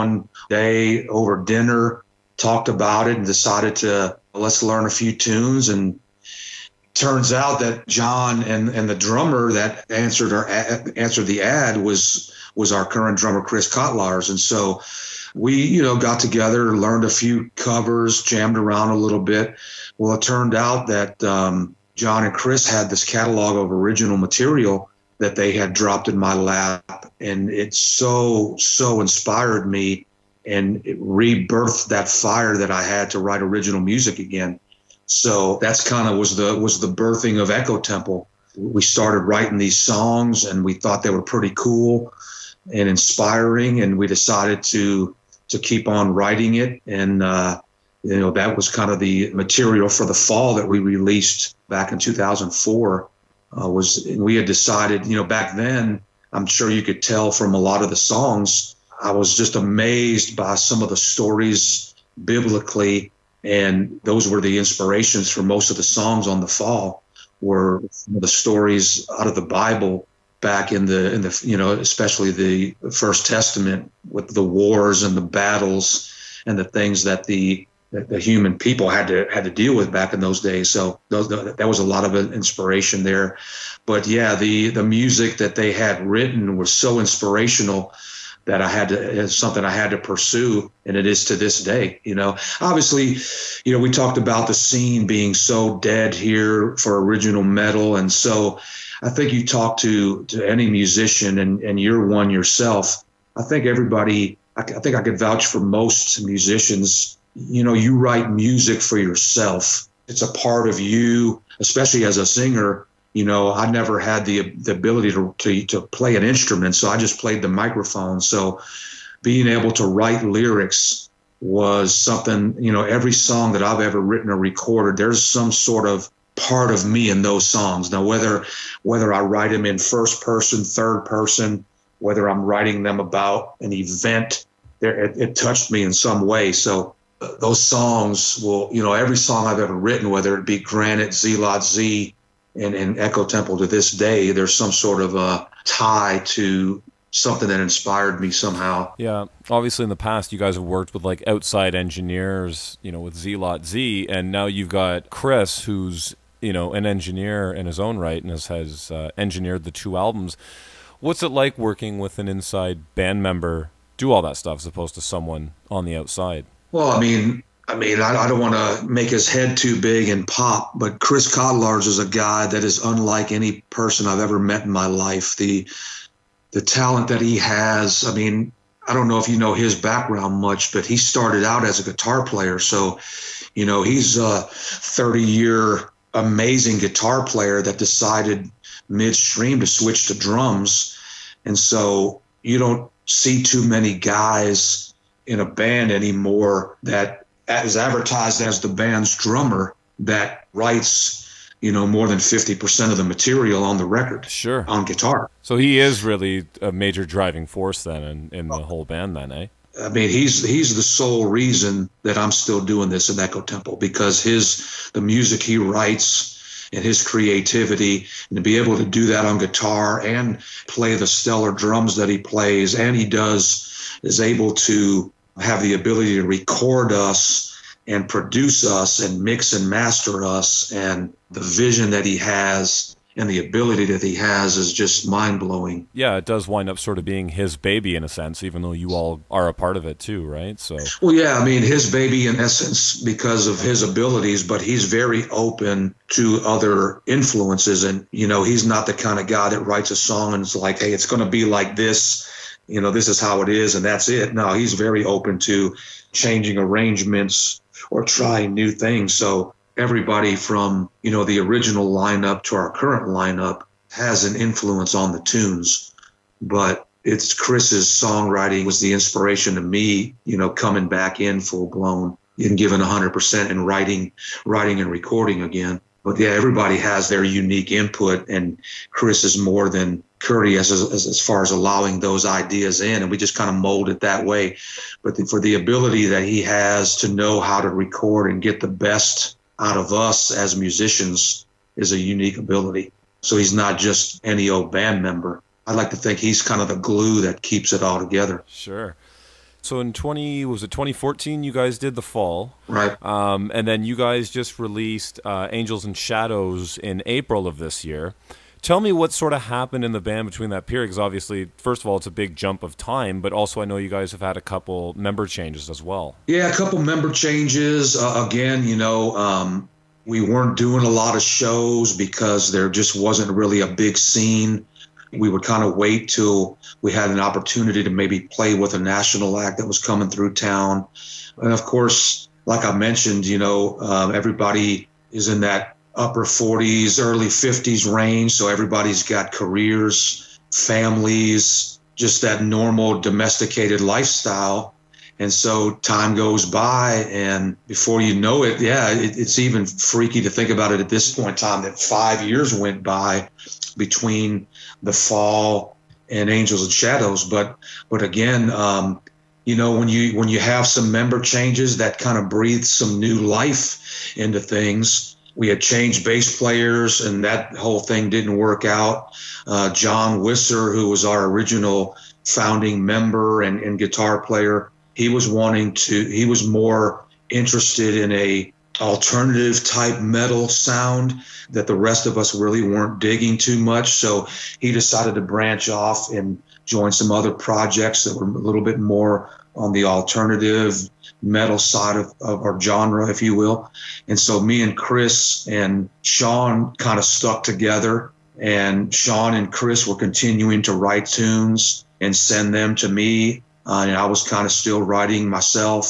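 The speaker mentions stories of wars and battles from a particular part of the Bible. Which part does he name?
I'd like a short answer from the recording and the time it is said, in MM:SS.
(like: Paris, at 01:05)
First Testament, at 01:12.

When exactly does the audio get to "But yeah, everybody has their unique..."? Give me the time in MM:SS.
04:36.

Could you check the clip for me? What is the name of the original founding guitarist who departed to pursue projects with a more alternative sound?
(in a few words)
John Wisser.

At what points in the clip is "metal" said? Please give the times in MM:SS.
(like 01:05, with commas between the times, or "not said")
01:37, 06:20, 06:31.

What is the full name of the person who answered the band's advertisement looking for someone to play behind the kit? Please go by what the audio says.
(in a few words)
Chris Kotlars.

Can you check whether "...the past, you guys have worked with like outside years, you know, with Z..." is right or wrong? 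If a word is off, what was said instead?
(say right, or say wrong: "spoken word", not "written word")
wrong: "engineers", not "years".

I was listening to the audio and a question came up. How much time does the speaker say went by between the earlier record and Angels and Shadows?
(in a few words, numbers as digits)
5 years.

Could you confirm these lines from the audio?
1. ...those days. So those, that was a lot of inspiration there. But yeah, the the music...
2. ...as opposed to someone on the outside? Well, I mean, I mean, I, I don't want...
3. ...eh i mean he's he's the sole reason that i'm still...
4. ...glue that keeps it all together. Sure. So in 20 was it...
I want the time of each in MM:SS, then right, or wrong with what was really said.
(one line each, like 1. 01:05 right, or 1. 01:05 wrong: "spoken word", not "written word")
1. 01:20 right
2. 02:44 right
3. 03:29 right
4. 04:56 right.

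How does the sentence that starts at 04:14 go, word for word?
No, he's very open to changing arrangements or trying new things.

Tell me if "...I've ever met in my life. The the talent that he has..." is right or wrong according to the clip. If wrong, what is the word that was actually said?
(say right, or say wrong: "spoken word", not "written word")
right.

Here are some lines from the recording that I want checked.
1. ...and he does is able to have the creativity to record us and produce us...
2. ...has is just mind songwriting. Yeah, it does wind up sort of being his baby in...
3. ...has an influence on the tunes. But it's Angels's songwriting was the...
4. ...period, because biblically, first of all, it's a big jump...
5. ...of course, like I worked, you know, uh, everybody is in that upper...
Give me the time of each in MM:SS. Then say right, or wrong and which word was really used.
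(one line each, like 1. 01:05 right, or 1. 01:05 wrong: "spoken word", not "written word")
1. 03:42 wrong: "ability", not "creativity"
2. 03:54 wrong: "blowing", not "songwriting"
3. 04:23 wrong: "Chris", not "Angels"
4. 05:10 wrong: "obviously", not "biblically"
5. 05:31 wrong: "mentioned", not "worked".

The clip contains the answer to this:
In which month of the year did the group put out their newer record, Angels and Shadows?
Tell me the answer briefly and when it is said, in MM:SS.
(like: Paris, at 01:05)
April, at 05:07.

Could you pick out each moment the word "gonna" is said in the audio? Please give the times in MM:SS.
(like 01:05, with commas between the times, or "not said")
04:11.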